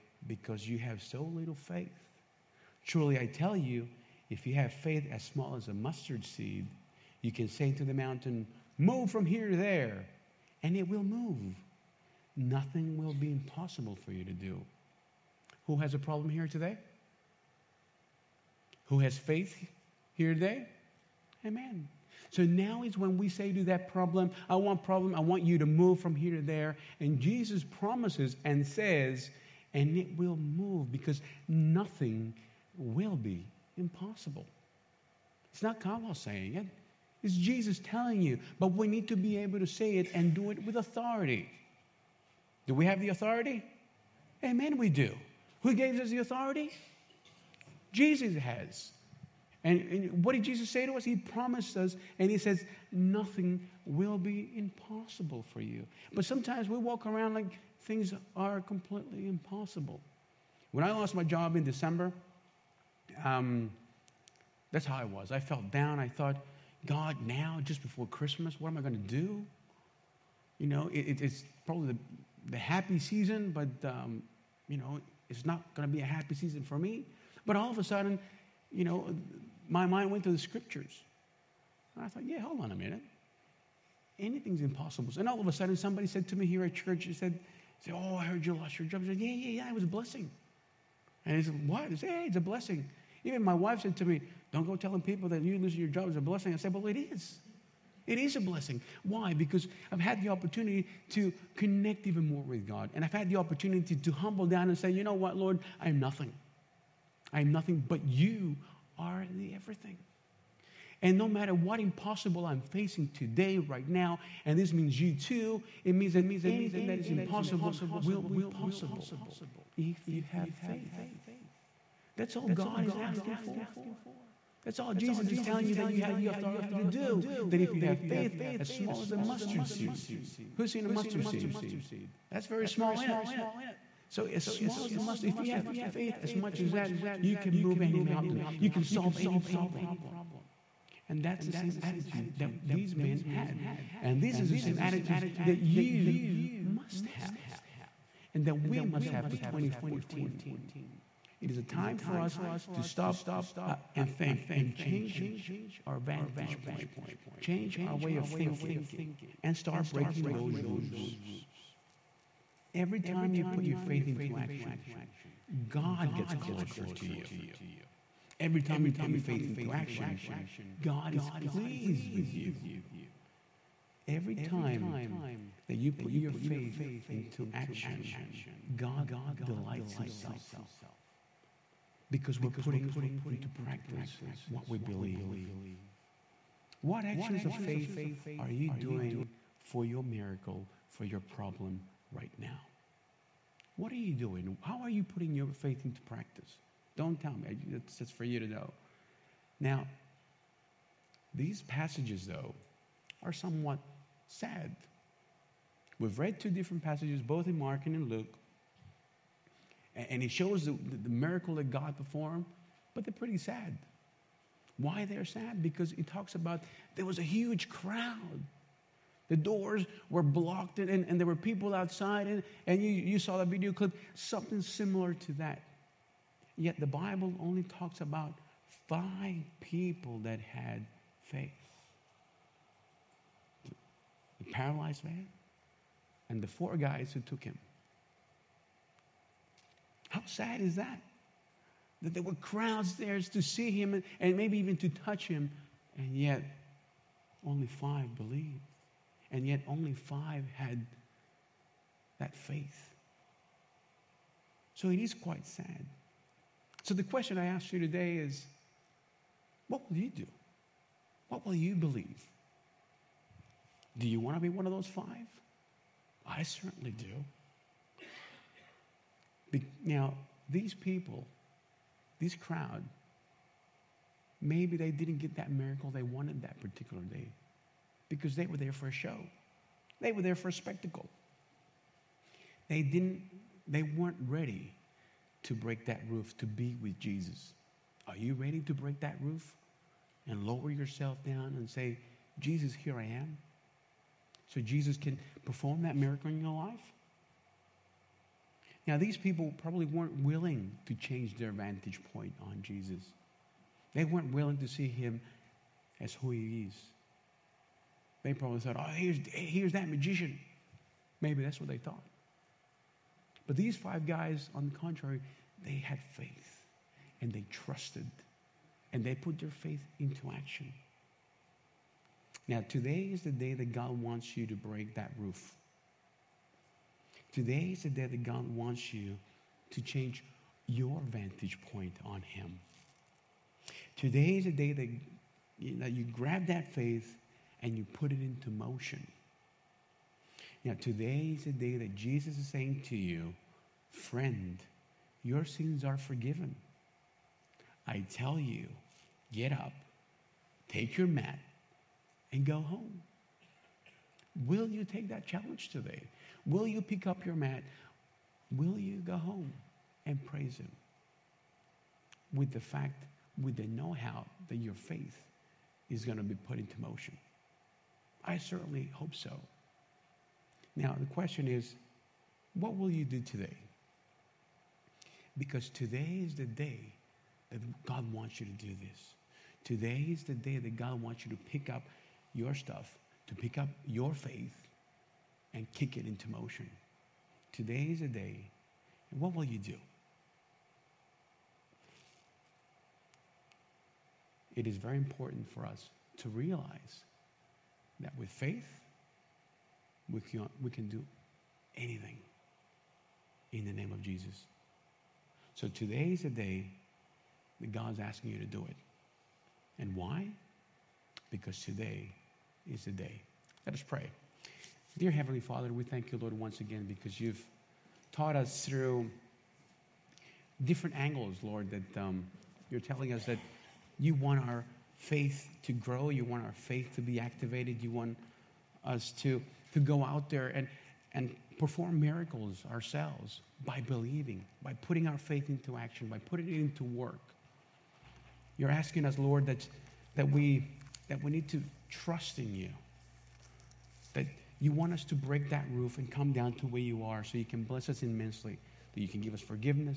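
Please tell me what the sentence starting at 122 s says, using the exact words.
That's all God is asking for.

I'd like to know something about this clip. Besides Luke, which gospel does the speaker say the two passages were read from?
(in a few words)
Mark.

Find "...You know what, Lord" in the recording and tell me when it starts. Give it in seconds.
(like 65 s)
104 s.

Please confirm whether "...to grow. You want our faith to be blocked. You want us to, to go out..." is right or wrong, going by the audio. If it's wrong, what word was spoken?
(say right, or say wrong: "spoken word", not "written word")
wrong: "activated", not "blocked".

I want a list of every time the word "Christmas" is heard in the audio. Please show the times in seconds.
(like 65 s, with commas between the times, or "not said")
68 s.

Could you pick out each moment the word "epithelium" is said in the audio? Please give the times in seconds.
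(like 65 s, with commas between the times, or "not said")
not said.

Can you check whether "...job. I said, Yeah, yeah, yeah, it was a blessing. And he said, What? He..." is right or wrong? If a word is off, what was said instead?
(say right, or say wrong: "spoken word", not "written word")
right.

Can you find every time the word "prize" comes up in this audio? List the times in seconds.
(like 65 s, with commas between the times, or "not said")
not said.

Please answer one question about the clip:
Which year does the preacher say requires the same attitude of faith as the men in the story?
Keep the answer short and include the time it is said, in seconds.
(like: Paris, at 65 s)
2014, at 149 s.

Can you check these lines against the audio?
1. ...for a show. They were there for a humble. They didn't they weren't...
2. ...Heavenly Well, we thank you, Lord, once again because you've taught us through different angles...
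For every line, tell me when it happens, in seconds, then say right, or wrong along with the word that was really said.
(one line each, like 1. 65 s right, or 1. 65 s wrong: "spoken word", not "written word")
1. 278 s wrong: "spectacle", not "humble"
2. 415 s wrong: "Father", not "Well".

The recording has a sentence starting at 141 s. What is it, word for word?
And that's the same attitude that these men had.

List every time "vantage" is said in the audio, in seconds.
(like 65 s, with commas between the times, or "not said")
155 s, 301 s, 331 s.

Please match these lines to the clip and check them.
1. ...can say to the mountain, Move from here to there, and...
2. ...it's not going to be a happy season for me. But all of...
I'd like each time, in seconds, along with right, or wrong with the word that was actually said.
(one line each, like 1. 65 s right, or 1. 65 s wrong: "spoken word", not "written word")
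1. 7 s right
2. 75 s right.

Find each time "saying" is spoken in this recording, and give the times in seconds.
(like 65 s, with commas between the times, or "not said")
36 s, 342 s.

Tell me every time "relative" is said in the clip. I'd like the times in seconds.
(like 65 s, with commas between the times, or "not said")
not said.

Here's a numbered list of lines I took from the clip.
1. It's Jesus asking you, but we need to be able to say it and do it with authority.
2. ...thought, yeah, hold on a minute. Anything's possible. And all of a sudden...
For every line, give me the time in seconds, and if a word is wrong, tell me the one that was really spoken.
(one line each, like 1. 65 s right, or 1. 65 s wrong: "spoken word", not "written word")
1. 37 s wrong: "telling", not "asking"
2. 82 s wrong: "impossible", not "possible".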